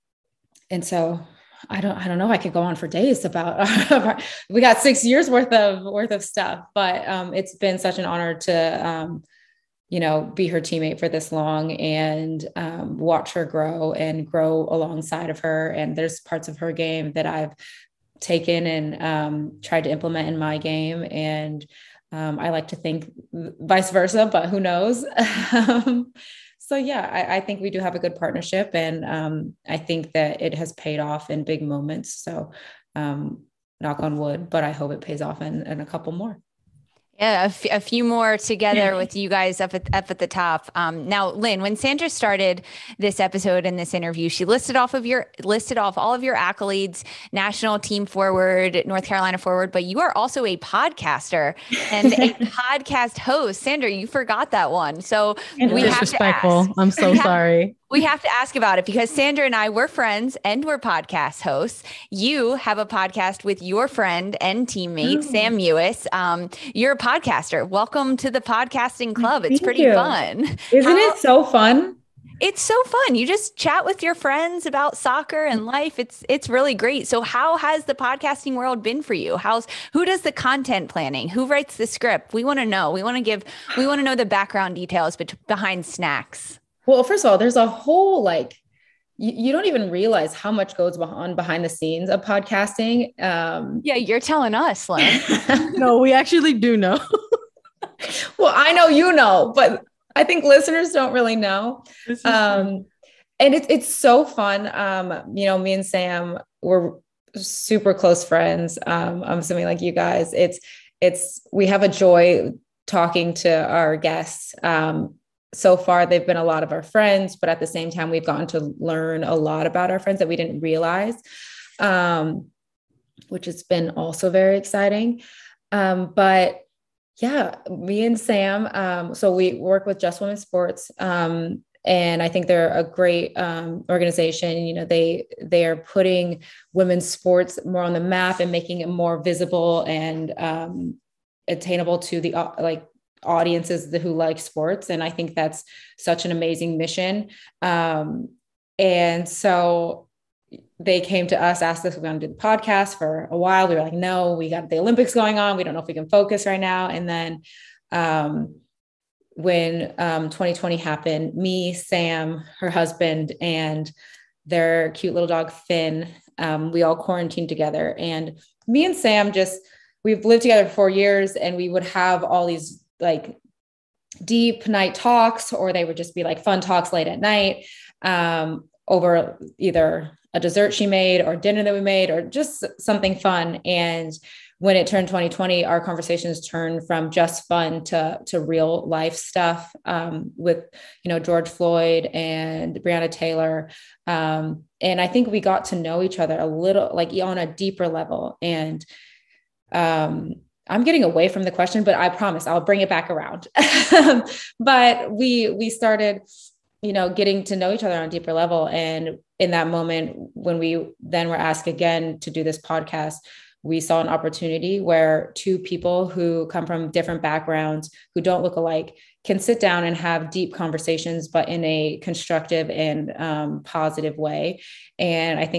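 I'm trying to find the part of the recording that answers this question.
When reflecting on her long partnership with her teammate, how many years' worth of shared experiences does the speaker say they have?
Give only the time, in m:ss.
0:04.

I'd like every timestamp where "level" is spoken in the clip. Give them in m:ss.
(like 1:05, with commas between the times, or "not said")
3:17, 3:28.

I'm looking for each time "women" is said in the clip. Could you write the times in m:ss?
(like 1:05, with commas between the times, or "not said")
2:10, 2:16.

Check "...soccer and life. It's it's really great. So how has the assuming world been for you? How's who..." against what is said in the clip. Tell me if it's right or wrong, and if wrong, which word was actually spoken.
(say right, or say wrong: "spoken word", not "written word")
wrong: "podcasting", not "assuming".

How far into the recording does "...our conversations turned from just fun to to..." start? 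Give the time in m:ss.
3:05.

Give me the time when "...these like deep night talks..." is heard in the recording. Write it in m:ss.
2:52.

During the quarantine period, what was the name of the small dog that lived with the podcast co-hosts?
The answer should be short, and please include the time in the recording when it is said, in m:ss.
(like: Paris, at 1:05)
Finn, at 2:45.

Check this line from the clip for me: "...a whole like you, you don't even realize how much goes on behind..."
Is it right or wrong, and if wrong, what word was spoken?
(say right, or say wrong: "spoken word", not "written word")
right.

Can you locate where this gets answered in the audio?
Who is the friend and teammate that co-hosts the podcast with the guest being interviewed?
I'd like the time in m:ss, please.
1:05.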